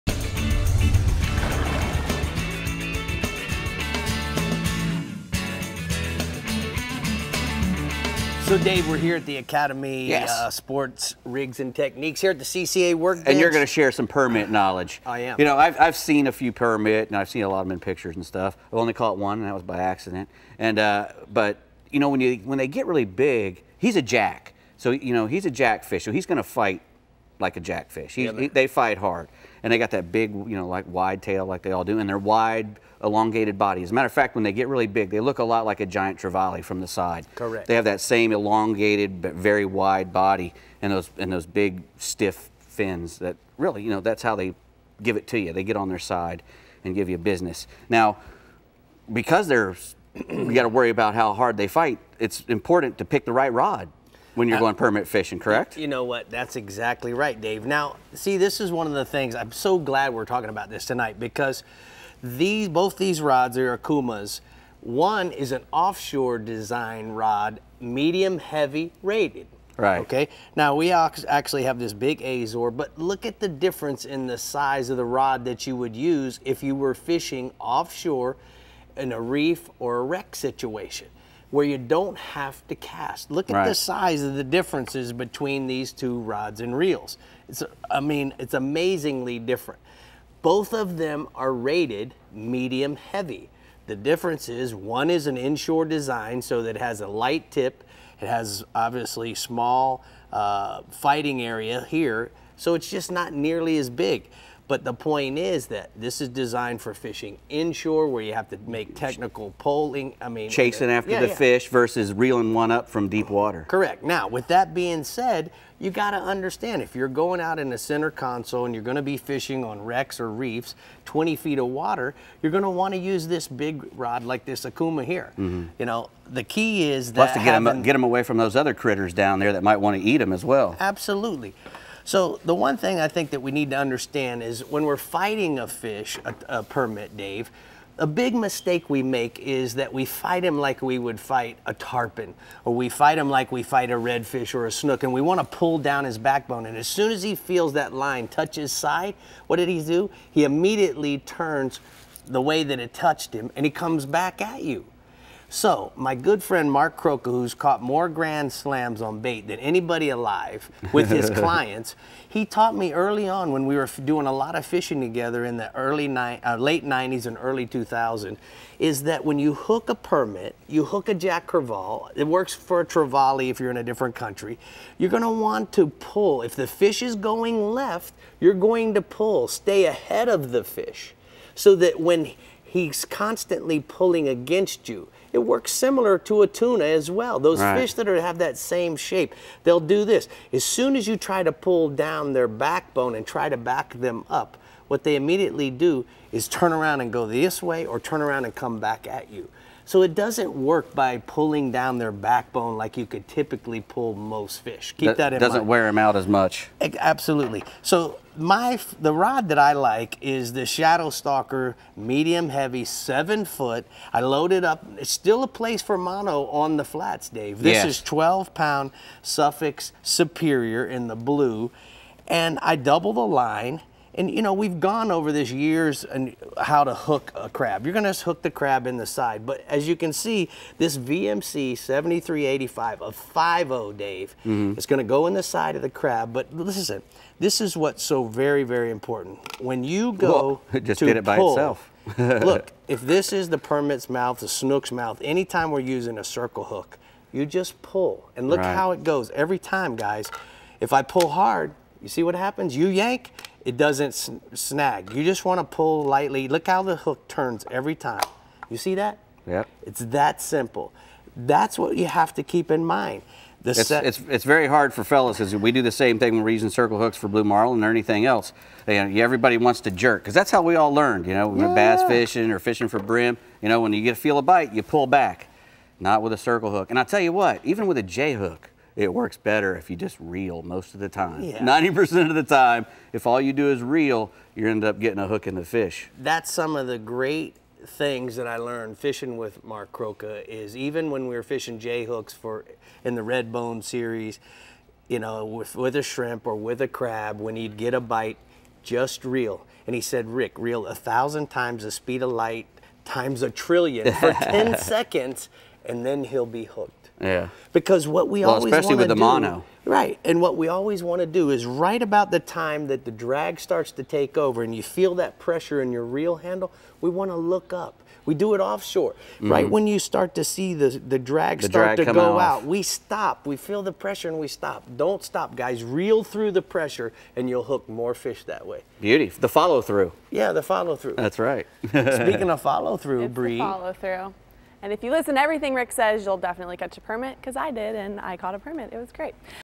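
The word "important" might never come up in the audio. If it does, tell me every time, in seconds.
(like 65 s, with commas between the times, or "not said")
52 s, 238 s.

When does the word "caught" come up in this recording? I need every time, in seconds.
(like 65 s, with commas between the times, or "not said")
18 s, 157 s, 338 s.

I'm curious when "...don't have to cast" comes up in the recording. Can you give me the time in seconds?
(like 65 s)
81 s.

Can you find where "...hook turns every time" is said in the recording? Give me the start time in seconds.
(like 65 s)
256 s.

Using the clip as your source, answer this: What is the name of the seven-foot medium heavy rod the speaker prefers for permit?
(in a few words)
Shadow Stalker.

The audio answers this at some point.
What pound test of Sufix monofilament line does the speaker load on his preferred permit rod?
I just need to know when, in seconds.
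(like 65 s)
218 s.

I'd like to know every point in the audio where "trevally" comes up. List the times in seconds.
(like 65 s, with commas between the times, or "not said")
36 s, 172 s.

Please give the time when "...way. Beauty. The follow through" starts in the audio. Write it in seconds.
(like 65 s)
328 s.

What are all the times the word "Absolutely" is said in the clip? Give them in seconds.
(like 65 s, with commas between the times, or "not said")
130 s, 206 s.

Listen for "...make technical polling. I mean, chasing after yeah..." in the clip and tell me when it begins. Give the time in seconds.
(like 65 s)
108 s.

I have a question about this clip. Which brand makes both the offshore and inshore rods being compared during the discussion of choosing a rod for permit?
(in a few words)
Okuma.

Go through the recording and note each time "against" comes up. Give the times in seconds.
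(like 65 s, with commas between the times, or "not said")
184 s.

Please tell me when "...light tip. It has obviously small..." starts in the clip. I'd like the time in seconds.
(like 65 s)
97 s.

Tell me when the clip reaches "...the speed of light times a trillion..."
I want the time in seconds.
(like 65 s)
301 s.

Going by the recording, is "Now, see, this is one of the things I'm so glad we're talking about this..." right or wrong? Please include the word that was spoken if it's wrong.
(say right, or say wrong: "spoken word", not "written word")
right.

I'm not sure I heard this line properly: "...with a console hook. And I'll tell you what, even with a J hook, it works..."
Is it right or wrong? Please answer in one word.
wrong.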